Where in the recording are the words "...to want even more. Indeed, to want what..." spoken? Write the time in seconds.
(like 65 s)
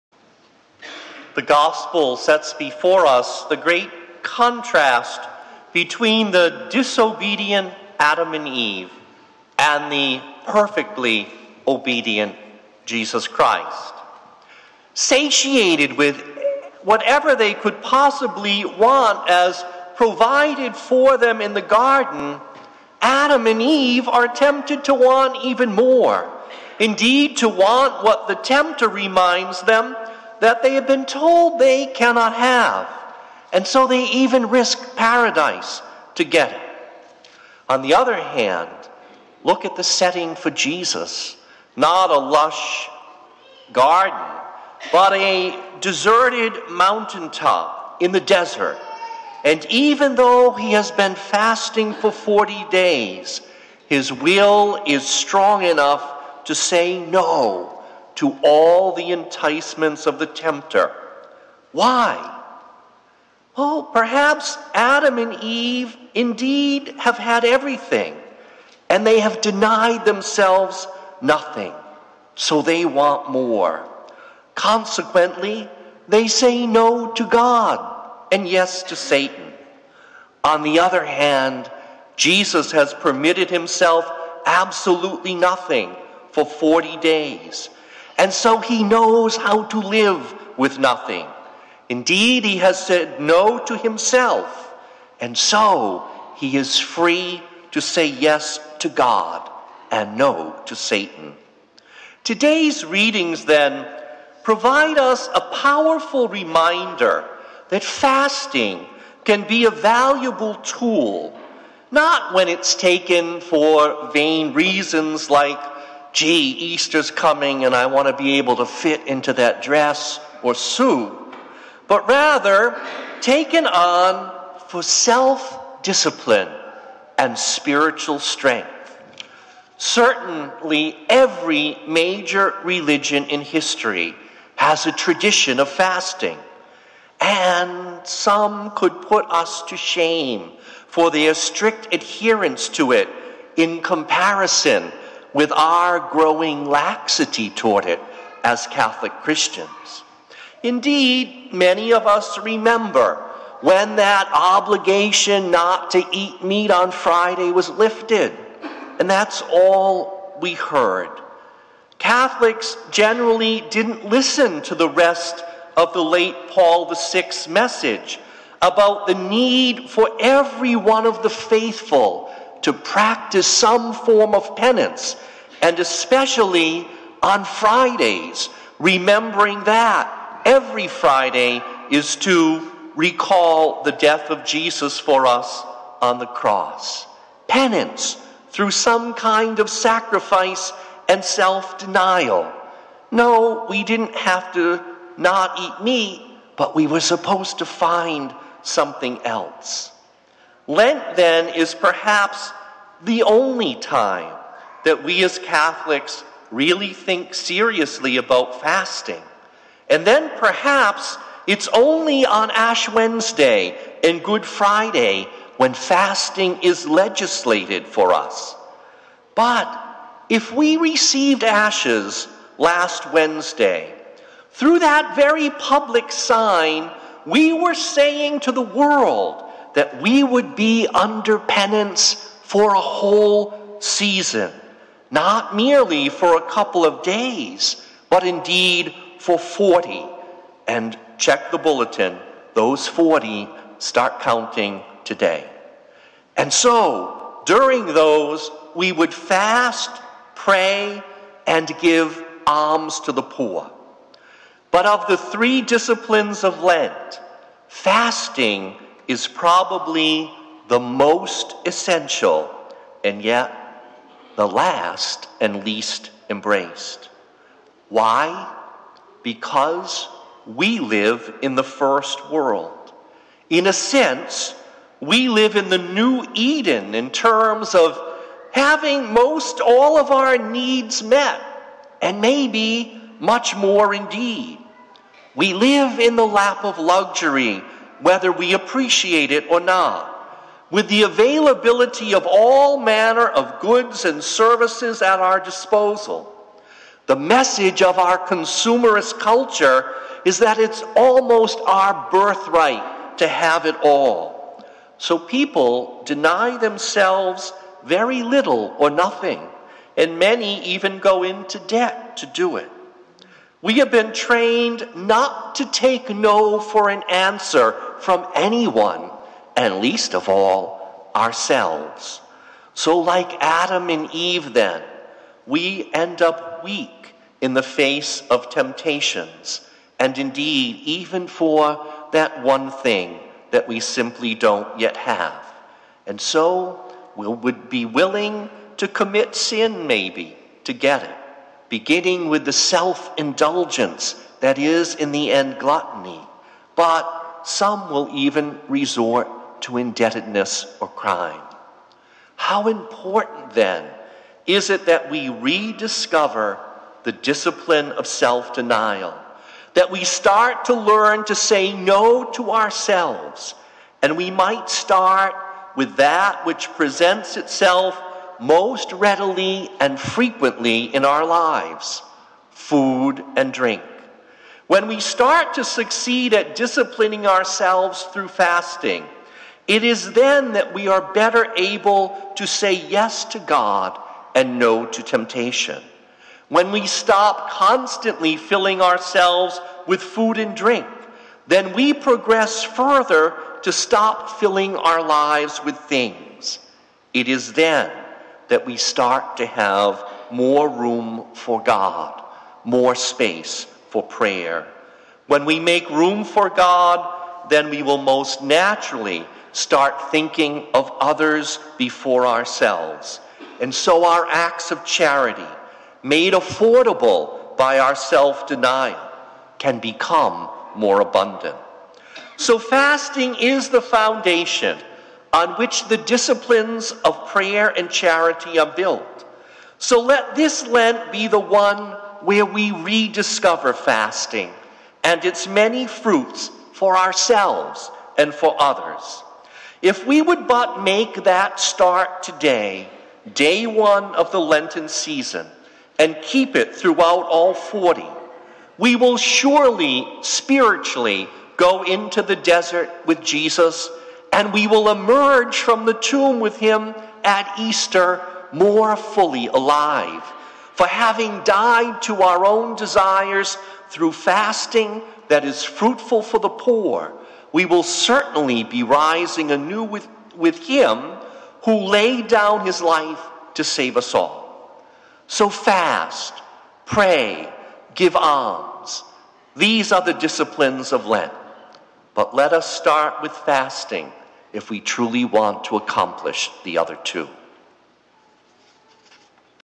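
24 s.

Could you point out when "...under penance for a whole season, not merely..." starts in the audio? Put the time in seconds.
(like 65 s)
230 s.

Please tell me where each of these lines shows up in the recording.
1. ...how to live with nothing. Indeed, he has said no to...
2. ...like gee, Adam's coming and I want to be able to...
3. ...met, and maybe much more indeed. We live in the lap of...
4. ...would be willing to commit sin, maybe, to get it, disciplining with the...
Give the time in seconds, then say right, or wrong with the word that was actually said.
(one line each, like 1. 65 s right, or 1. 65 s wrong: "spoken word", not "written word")
1. 89 s right
2. 115 s wrong: "Easter", not "Adam"
3. 281 s right
4. 337 s wrong: "beginning", not "disciplining".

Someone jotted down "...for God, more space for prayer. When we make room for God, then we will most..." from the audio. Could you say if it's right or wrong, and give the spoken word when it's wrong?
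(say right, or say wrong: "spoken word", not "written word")
right.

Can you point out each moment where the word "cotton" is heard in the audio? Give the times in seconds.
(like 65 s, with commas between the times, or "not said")
not said.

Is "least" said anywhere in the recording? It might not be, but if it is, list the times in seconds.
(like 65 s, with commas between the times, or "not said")
265 s, 319 s.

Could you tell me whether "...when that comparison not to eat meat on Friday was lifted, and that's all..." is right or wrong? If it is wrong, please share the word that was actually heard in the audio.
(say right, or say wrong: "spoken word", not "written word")
wrong: "obligation", not "comparison".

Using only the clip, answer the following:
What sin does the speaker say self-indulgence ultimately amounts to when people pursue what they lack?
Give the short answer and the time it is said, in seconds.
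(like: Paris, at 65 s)
gluttony, at 345 s.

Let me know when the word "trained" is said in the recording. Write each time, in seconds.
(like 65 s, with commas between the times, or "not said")
314 s.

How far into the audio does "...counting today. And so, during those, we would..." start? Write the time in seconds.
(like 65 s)
244 s.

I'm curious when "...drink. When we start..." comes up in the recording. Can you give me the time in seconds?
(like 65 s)
373 s.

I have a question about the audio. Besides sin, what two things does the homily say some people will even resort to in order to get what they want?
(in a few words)
indebtedness or crime.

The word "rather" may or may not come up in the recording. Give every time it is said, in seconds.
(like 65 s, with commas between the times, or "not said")
122 s.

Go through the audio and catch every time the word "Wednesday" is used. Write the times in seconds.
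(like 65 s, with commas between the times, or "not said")
212 s, 223 s.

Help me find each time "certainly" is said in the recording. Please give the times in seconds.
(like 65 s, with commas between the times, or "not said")
129 s, 467 s.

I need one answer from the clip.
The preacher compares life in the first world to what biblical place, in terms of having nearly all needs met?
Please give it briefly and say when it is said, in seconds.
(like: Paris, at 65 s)
the new Eden, at 275 s.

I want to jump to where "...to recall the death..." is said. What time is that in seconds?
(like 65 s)
182 s.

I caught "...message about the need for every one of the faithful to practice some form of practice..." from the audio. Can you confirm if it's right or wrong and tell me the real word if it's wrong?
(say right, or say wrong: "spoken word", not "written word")
wrong: "penance", not "practice".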